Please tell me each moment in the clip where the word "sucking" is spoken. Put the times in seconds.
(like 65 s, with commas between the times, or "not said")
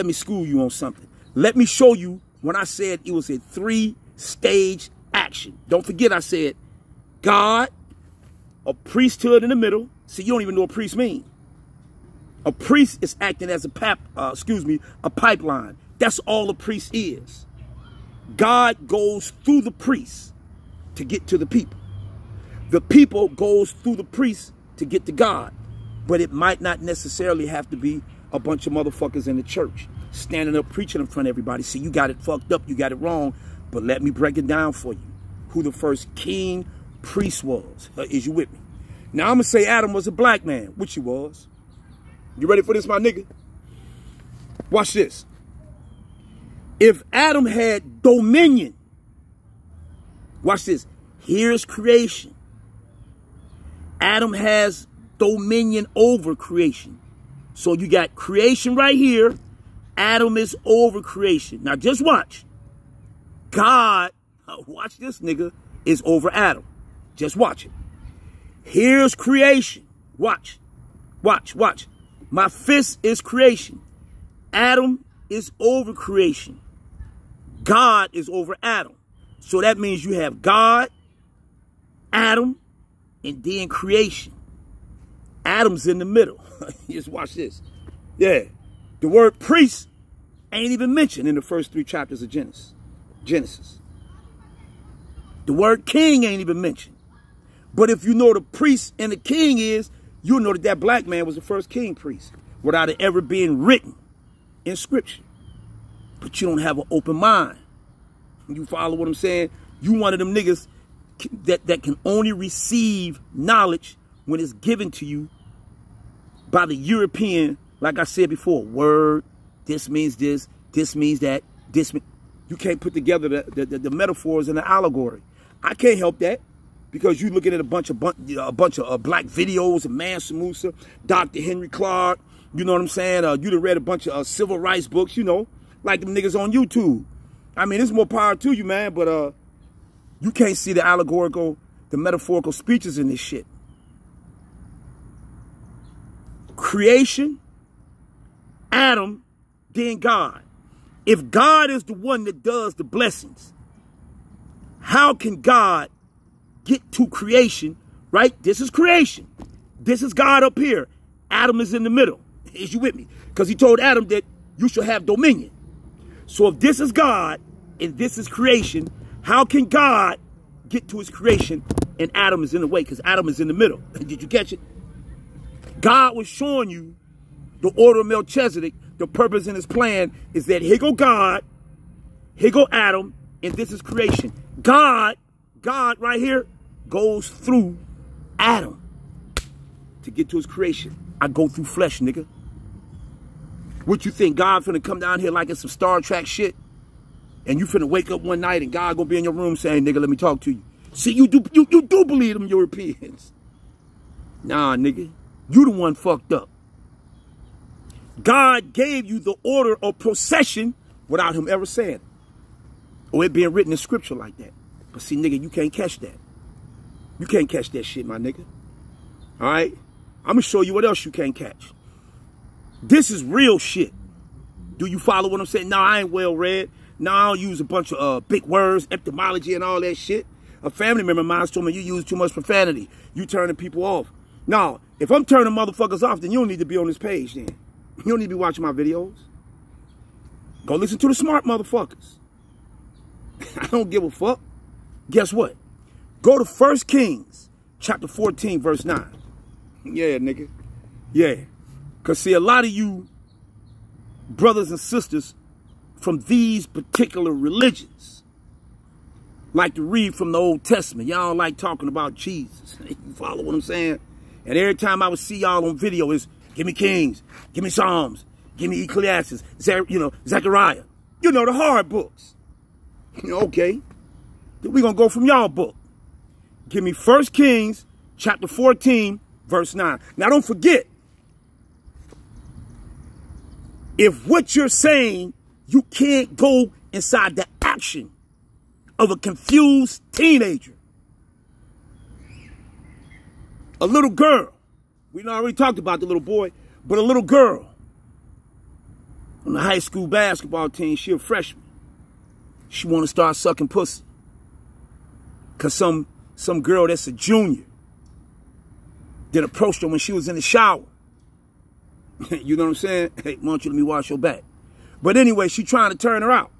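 303 s.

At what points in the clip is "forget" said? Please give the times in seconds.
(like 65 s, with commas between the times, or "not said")
5 s, 280 s.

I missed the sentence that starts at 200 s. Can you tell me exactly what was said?
See, you do you, you do believe them Europeans.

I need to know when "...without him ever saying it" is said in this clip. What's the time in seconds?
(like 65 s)
211 s.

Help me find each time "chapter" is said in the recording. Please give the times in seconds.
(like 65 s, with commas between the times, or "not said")
91 s, 247 s, 278 s.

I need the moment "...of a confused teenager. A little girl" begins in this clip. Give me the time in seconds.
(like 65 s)
288 s.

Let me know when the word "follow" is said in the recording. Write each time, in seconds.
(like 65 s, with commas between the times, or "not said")
108 s, 224 s, 263 s.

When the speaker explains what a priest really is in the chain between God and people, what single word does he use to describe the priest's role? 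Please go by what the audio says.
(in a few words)
pipeline.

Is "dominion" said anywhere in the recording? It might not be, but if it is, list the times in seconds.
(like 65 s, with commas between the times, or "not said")
48 s, 55 s, 165 s.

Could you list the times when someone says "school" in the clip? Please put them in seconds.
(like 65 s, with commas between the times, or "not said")
0 s, 299 s.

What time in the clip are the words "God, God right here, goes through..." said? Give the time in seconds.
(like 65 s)
184 s.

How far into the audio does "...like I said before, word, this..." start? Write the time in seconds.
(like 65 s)
117 s.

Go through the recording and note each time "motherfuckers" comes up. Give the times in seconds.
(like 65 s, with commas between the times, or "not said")
28 s, 235 s, 241 s.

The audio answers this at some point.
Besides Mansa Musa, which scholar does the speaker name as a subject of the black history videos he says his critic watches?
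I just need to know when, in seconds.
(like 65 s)
131 s.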